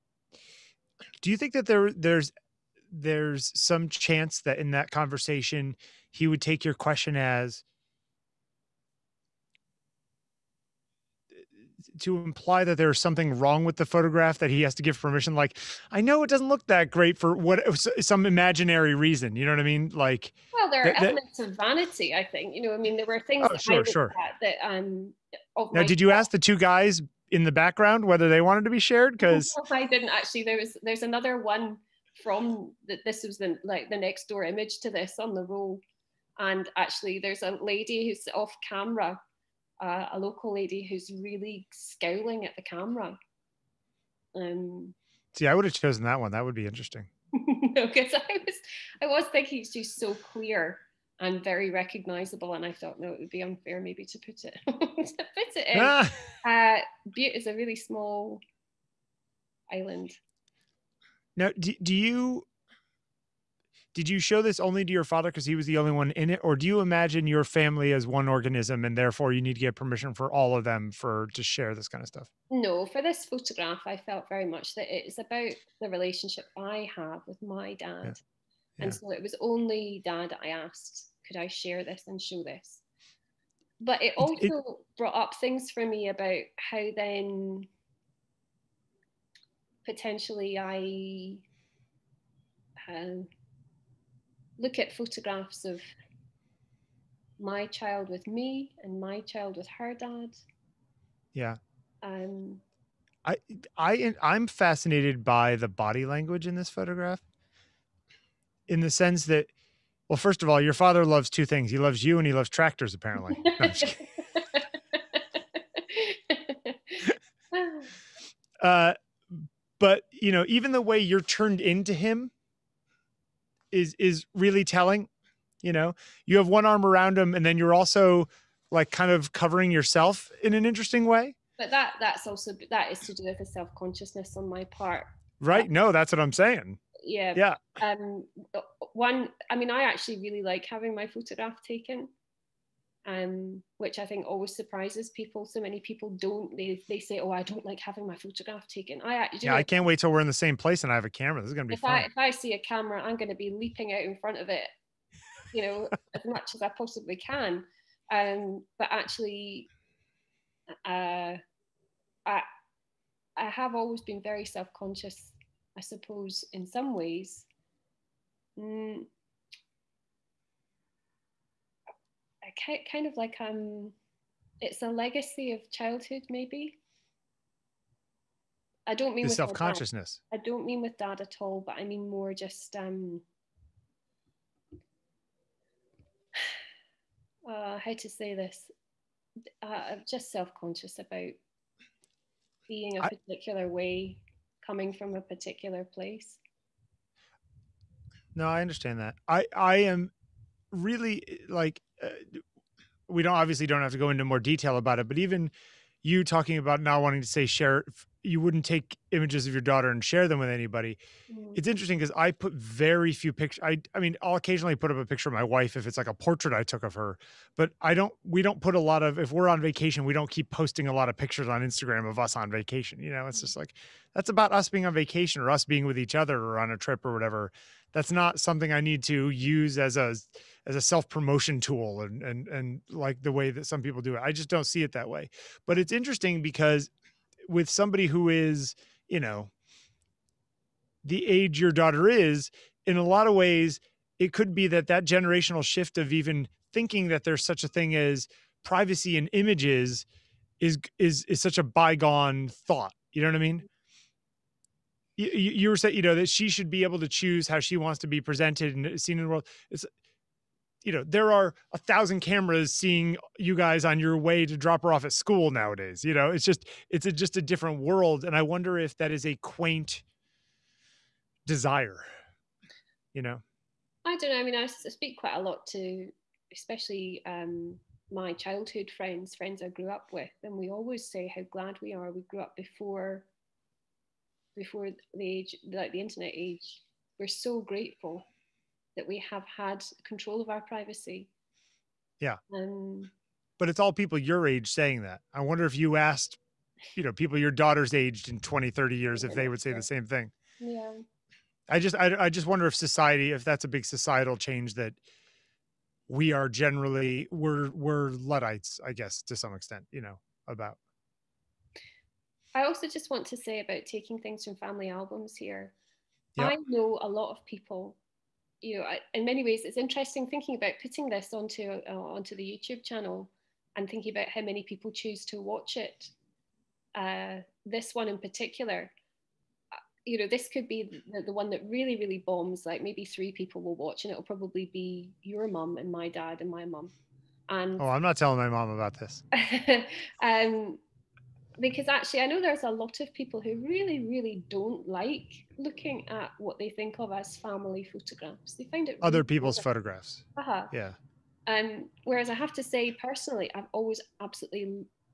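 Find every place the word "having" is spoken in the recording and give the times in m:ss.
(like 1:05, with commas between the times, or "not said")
2:20, 2:27.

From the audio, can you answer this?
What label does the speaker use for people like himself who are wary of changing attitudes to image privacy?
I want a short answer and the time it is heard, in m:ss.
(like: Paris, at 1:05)
Luddites, at 5:08.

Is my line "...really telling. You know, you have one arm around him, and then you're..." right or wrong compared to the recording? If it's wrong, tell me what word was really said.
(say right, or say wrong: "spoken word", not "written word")
right.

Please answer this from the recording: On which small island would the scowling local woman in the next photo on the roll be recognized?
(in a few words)
Bute.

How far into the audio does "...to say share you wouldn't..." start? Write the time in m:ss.
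3:27.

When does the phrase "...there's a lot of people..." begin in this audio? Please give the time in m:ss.
5:42.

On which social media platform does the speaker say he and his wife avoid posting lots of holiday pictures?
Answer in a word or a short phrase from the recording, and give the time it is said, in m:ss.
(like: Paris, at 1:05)
Instagram, at 3:41.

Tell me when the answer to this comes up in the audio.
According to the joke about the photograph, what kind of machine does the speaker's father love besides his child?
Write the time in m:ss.
1:52.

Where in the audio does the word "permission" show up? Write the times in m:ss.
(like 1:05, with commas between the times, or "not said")
0:14, 1:09.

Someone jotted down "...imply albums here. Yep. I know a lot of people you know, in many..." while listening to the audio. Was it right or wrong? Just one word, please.
wrong.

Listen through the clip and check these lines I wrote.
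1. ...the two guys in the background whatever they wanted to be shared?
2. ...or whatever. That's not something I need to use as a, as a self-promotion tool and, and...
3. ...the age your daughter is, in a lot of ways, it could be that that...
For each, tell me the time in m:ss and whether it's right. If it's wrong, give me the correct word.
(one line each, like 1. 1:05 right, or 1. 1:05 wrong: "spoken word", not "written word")
1. 0:26 wrong: "whether", not "whatever"
2. 3:47 right
3. 4:01 right.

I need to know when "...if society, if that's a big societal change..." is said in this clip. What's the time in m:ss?
5:02.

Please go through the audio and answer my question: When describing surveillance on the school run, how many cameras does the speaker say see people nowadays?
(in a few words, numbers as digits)
1000.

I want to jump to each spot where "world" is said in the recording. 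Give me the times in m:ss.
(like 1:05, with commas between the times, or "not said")
4:19, 4:27.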